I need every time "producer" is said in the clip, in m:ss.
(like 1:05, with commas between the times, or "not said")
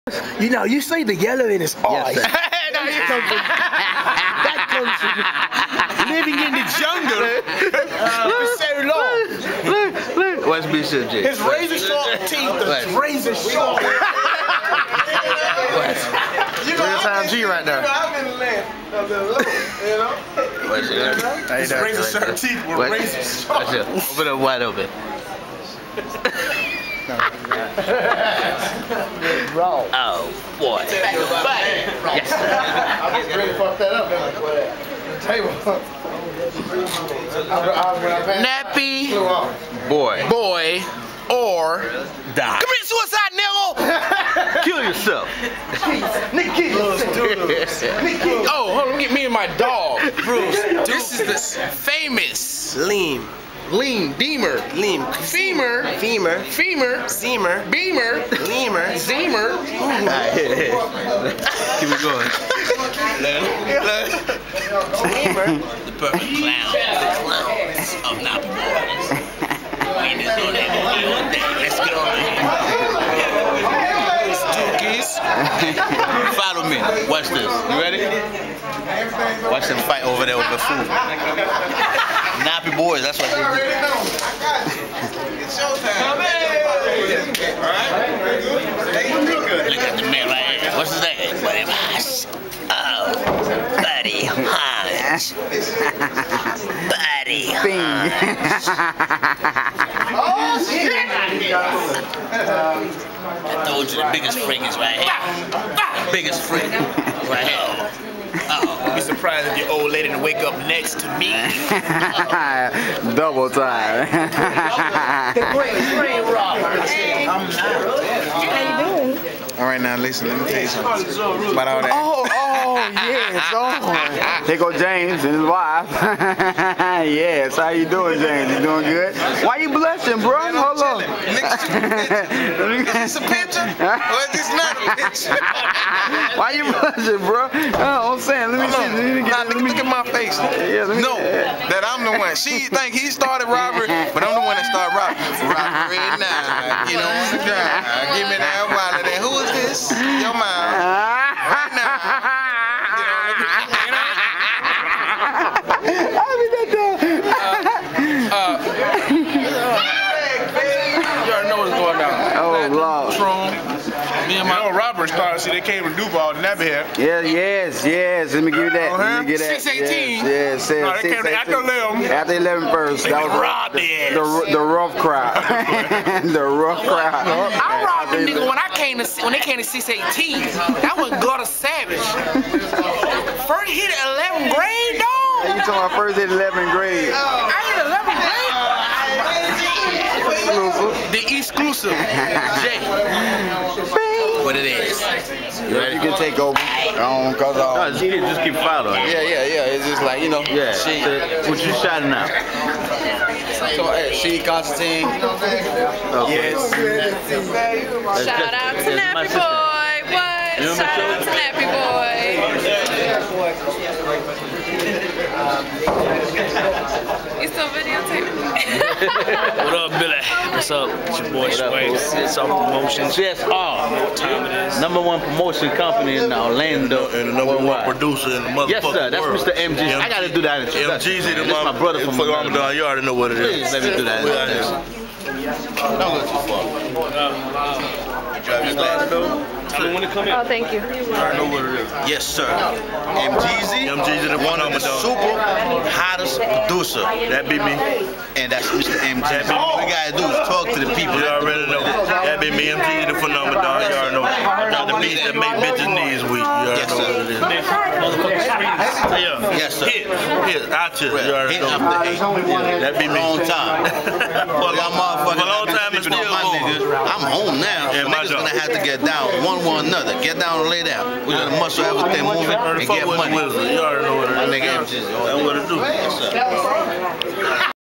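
3:47, 4:06.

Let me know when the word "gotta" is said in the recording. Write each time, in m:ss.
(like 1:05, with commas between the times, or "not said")
3:50, 4:09.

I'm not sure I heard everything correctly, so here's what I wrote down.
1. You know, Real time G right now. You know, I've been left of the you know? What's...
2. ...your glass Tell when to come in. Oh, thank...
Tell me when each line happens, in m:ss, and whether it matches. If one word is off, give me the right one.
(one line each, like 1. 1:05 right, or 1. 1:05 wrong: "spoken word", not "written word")
1. 0:16 right
2. 3:58 right.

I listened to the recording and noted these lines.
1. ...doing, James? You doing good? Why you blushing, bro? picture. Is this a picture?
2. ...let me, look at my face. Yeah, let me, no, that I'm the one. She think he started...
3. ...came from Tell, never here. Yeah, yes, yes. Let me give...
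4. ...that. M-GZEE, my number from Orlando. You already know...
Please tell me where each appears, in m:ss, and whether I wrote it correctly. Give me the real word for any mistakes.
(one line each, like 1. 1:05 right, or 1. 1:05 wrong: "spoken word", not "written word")
1. 2:07 right
2. 2:19 right
3. 2:45 wrong: "Duval", not "Tell"
4. 3:50 wrong: "brother", not "number".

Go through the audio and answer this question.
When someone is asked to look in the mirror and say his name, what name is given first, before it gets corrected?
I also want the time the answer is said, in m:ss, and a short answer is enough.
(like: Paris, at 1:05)
Buddy Boss, at 1:31.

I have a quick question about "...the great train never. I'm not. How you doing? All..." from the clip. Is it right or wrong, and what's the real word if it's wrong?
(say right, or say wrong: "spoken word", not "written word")
wrong: "robber", not "never".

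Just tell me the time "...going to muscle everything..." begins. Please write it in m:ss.
4:31.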